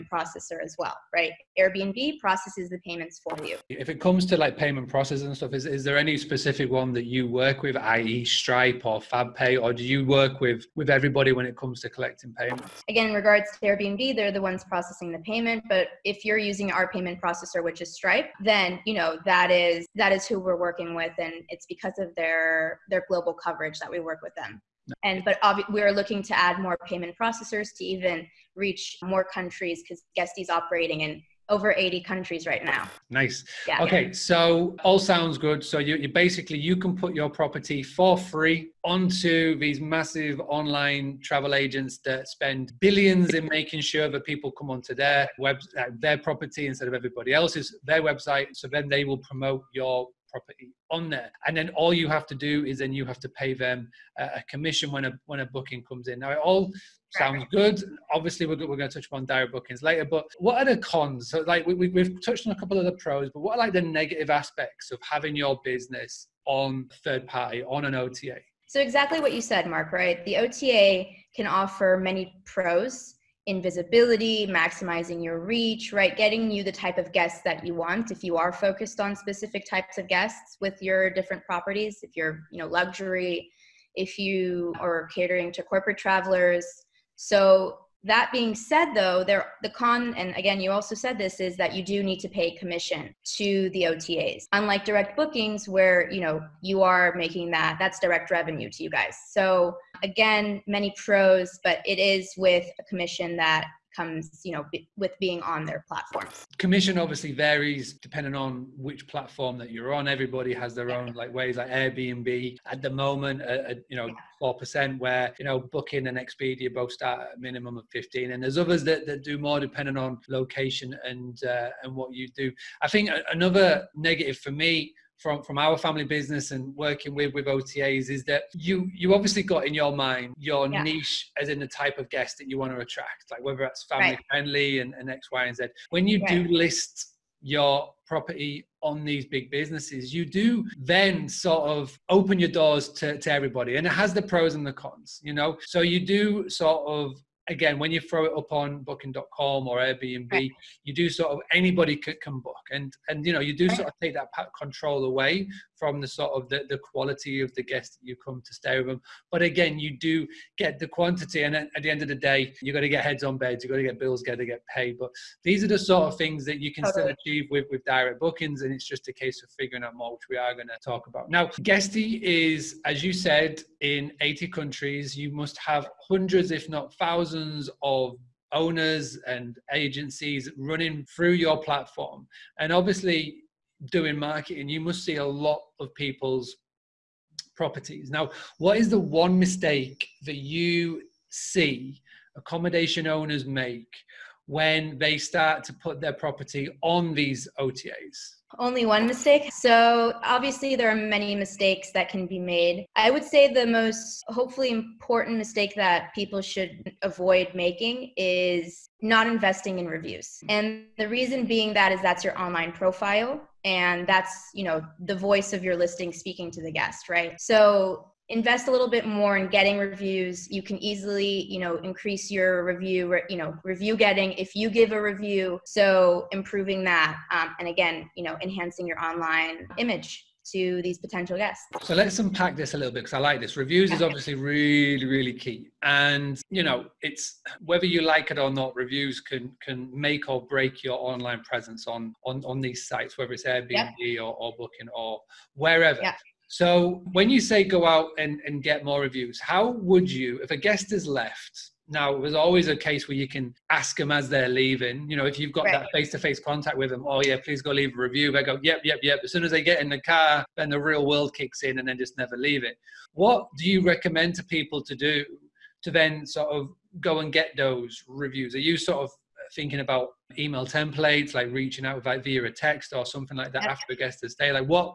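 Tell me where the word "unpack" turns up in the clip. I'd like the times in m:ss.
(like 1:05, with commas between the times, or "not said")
3:52.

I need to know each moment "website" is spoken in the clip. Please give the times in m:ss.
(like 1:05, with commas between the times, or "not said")
0:48.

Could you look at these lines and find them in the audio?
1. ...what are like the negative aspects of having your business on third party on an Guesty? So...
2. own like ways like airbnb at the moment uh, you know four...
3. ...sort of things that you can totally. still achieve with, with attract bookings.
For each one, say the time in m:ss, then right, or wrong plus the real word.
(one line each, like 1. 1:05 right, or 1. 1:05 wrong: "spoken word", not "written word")
1. 1:03 wrong: "OTA", not "Guesty"
2. 1:50 right
3. 2:45 wrong: "direct", not "attract".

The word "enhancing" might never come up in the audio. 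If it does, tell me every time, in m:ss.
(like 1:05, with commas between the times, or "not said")
3:48.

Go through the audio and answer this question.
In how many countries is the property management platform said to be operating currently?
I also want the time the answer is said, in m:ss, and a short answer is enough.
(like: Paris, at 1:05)
over 80, at 0:31.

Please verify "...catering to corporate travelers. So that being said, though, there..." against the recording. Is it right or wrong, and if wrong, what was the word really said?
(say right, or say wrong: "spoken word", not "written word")
right.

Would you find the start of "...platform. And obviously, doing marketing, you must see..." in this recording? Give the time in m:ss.
3:01.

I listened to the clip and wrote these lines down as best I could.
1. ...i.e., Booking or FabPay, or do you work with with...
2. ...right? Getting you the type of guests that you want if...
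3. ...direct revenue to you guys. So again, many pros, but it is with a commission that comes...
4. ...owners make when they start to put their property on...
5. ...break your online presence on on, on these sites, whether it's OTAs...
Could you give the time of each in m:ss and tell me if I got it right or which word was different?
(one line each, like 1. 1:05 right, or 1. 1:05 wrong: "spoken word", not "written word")
1. 0:07 wrong: "Stripe", not "Booking"
2. 1:15 right
3. 1:37 right
4. 3:13 right
5. 4:00 wrong: "Airbnb", not "OTAs".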